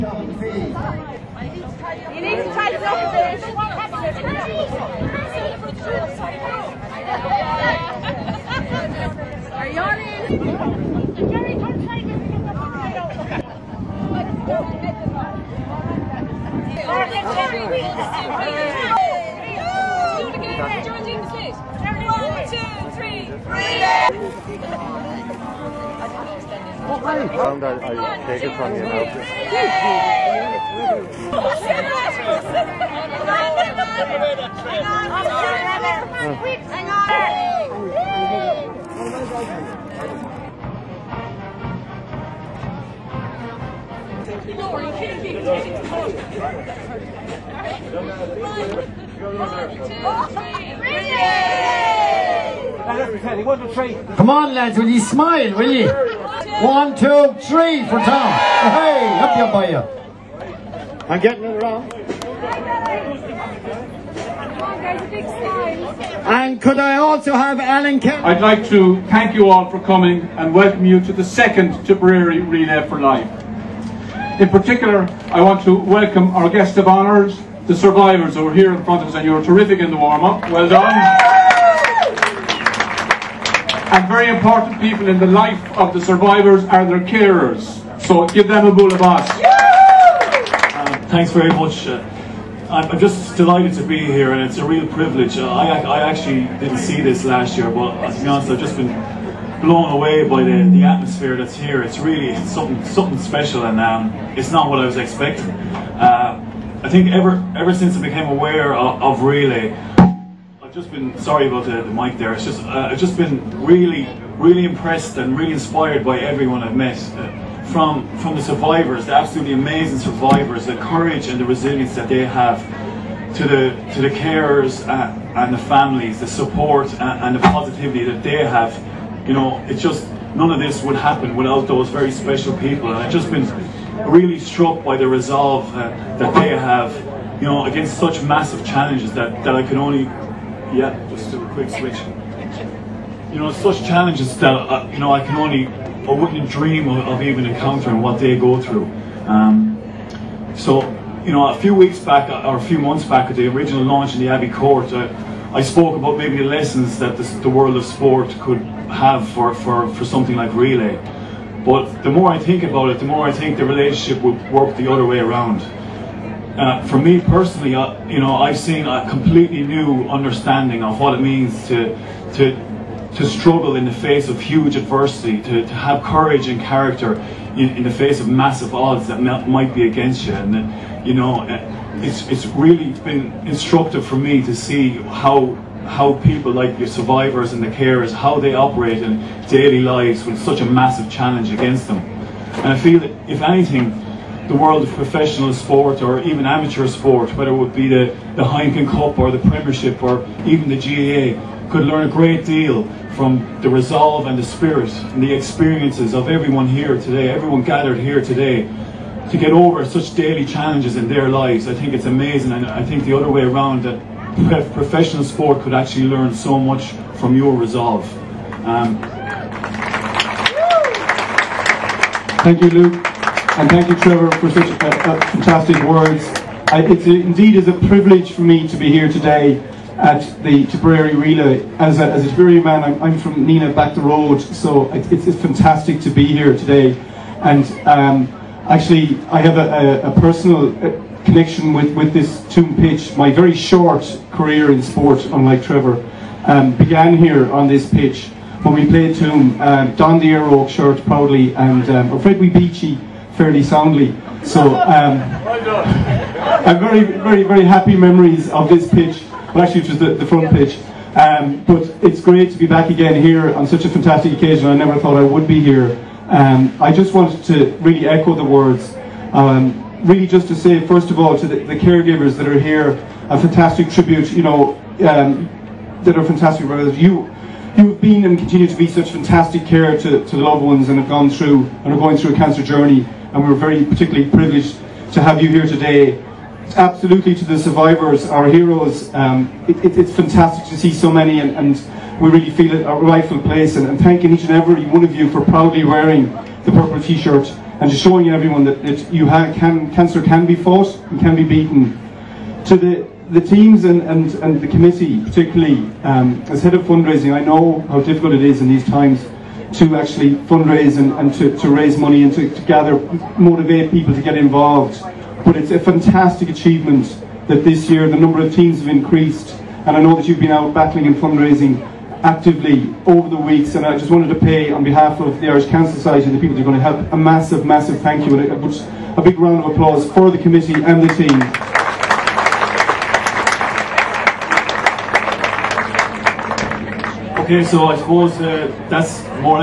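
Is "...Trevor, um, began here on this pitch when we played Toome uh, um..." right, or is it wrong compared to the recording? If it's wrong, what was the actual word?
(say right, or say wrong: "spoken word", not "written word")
right.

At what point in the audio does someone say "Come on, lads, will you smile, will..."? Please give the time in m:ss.
0:54.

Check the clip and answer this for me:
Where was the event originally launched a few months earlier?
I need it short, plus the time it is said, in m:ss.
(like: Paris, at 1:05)
The Abbey Court, at 2:34.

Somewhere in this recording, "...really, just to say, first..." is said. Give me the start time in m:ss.
4:30.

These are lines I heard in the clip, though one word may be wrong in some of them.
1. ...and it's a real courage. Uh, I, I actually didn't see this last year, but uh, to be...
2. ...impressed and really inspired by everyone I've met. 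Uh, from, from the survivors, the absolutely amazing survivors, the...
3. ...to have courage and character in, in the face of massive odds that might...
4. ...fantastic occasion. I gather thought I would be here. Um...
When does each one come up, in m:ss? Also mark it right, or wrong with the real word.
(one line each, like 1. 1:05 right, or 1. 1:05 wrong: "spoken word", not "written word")
1. 1:34 wrong: "privilege", not "courage"
2. 1:54 right
3. 2:55 right
4. 4:23 wrong: "never", not "gather".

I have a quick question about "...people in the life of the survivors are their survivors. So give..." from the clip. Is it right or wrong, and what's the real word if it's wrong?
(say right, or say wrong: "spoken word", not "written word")
wrong: "carers", not "survivors".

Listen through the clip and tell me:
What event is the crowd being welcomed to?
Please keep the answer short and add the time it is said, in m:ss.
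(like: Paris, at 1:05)
Tipperary Relay for Life, at 1:11.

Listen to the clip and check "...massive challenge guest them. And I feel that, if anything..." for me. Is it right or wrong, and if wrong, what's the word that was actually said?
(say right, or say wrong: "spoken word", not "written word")
wrong: "against", not "guest".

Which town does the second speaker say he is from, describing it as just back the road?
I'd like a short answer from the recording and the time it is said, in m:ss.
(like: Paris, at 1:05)
Nenagh, at 3:53.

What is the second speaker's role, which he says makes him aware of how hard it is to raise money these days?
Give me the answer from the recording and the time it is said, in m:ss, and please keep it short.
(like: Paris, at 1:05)
Head of fundraising, at 5:06.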